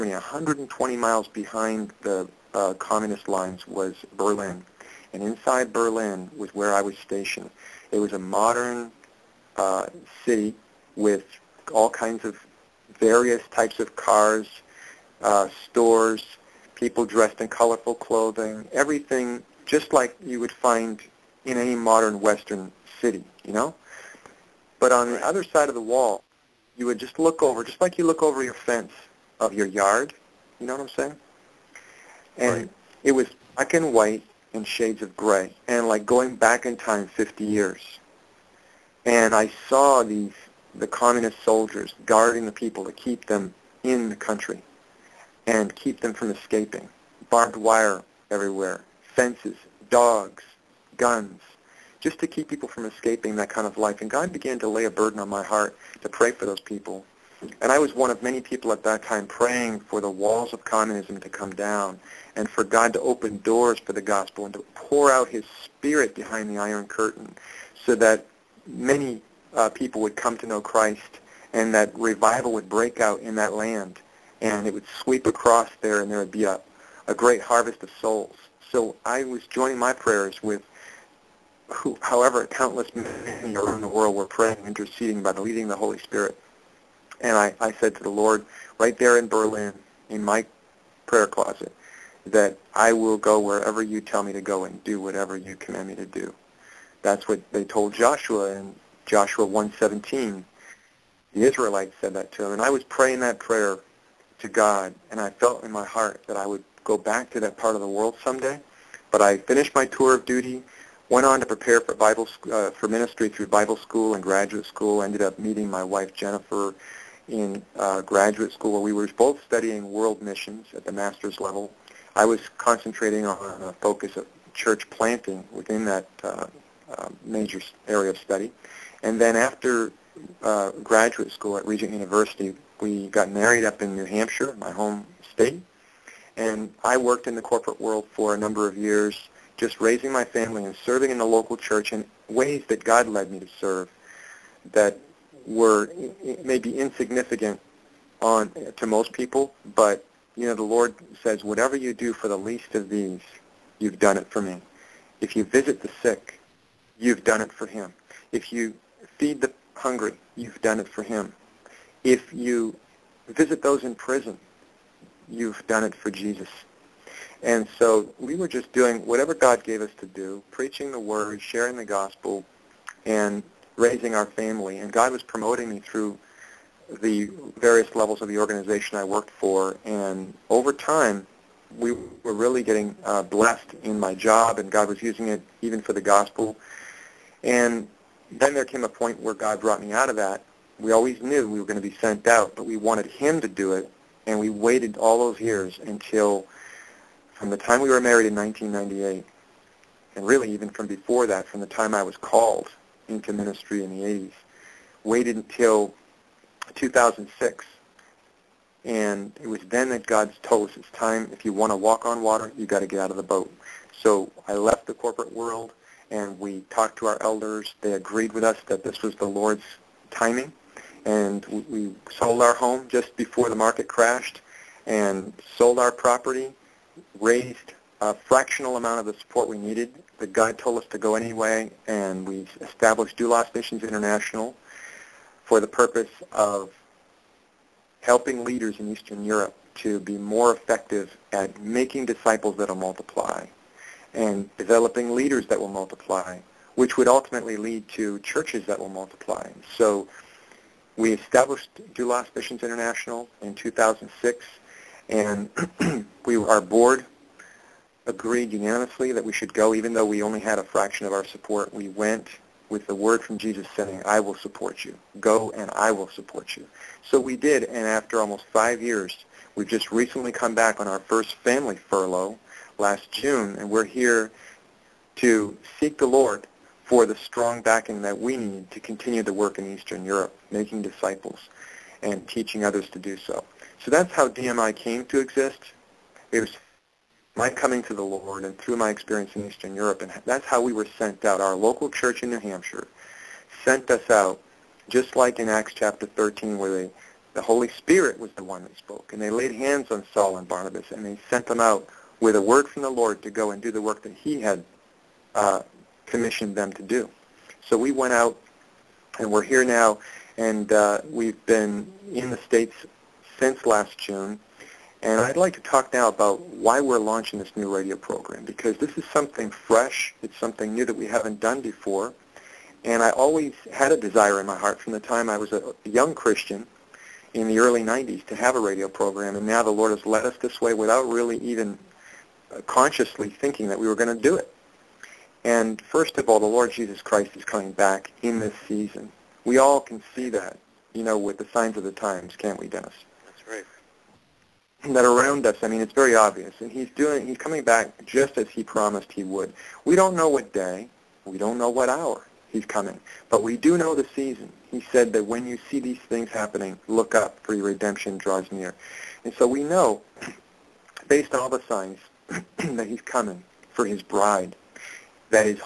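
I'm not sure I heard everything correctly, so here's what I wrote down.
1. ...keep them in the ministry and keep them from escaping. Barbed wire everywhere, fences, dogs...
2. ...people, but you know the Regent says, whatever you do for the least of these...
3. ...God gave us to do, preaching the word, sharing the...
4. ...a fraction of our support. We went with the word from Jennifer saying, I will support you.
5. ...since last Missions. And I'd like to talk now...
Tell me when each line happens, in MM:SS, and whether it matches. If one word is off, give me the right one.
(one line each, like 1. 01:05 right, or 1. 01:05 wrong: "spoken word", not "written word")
1. 00:42 wrong: "country", not "ministry"
2. 02:29 wrong: "Lord", not "Regent"
3. 02:49 right
4. 04:20 wrong: "Jesus", not "Jennifer"
5. 05:13 wrong: "June", not "Missions".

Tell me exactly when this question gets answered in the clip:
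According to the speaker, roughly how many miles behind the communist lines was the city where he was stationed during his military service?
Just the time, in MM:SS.
00:00.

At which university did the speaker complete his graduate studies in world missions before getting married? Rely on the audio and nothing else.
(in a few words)
Regent University.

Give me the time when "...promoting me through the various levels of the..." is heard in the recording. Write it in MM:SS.
02:55.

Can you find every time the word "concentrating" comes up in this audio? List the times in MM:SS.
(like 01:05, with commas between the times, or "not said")
02:02.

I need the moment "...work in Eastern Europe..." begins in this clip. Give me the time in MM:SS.
04:39.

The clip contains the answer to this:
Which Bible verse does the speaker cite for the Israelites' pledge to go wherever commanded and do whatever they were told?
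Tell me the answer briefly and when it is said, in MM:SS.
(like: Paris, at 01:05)
Joshua 1:17, at 01:39.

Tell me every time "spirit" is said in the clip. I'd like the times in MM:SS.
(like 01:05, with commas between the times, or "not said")
01:05, 01:25, 04:57.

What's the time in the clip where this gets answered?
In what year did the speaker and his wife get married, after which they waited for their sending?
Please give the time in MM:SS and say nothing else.
03:18.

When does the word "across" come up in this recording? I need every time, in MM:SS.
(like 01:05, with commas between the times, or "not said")
01:15.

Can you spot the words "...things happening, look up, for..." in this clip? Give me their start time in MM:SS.
05:56.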